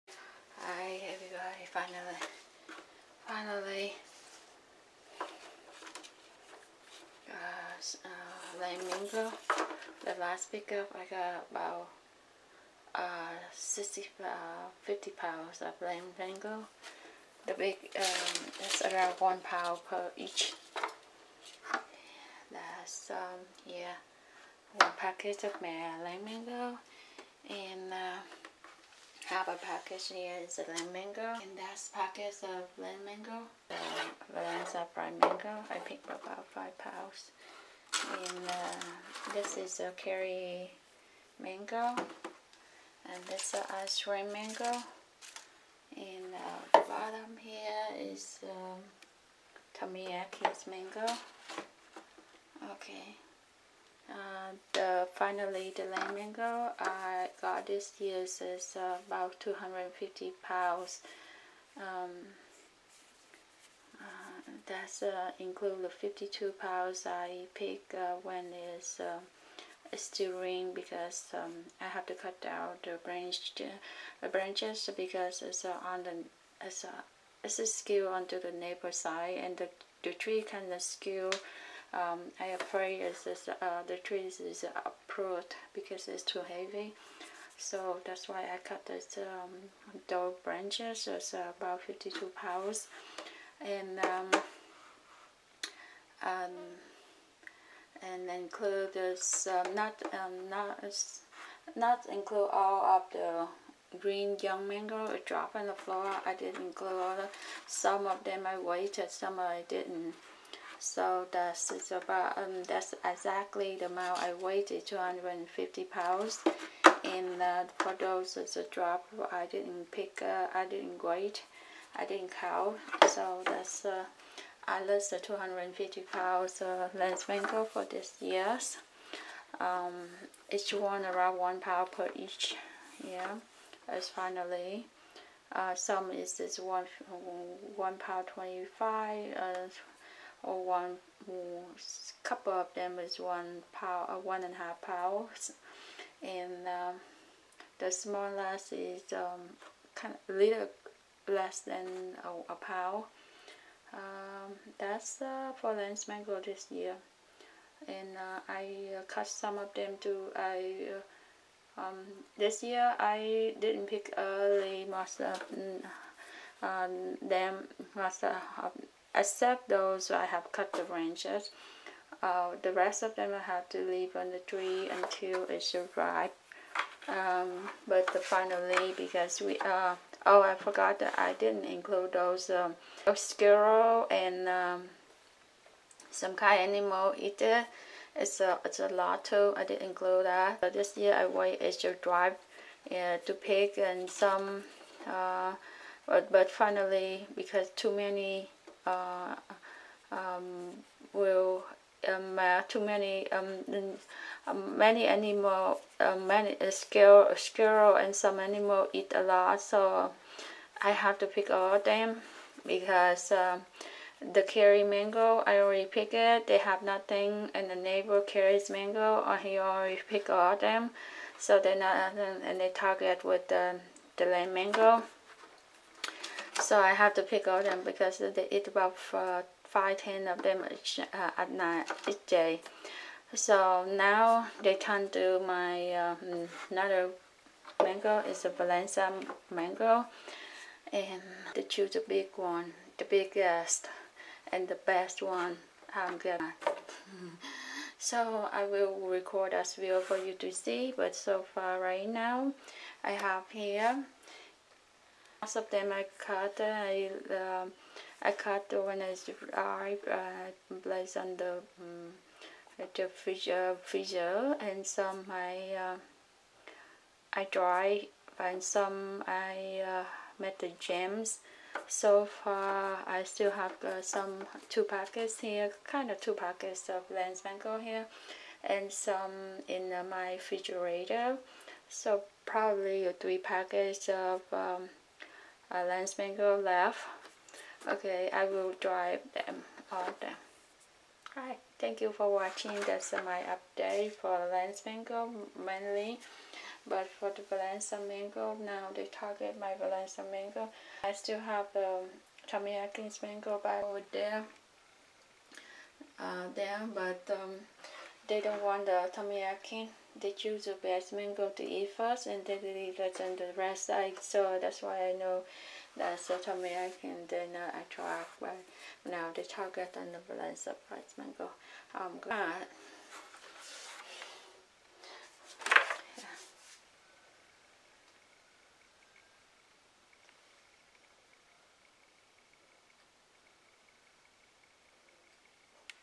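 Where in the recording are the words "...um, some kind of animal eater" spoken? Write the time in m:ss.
3:04.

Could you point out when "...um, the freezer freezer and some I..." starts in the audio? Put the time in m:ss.
4:21.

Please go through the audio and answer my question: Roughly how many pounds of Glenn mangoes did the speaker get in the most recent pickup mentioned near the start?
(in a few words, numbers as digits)
50 pounds.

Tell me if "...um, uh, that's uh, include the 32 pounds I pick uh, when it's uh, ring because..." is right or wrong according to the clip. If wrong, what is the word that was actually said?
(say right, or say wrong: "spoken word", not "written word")
wrong: "52", not "32".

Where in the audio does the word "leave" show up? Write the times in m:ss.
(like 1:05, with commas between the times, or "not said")
2:53, 5:12.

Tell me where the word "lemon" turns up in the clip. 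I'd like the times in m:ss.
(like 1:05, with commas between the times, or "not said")
0:30, 0:55.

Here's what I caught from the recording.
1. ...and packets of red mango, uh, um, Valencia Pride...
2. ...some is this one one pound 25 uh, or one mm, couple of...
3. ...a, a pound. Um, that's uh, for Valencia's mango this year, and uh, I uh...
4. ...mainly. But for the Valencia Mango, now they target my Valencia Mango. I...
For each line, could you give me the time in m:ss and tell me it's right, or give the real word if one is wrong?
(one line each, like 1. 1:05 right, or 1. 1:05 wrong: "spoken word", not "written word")
1. 0:31 right
2. 2:15 right
3. 2:32 wrong: "Glenn", not "Valencia"
4. 4:55 right.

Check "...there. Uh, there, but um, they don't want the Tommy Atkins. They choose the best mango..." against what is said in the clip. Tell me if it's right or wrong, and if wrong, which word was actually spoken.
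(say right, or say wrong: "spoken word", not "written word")
right.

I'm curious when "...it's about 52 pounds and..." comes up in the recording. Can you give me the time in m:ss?
1:31.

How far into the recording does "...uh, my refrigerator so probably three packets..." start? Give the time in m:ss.
4:39.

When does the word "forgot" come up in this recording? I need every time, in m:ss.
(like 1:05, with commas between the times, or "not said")
3:00.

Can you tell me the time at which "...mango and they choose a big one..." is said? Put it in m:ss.
3:59.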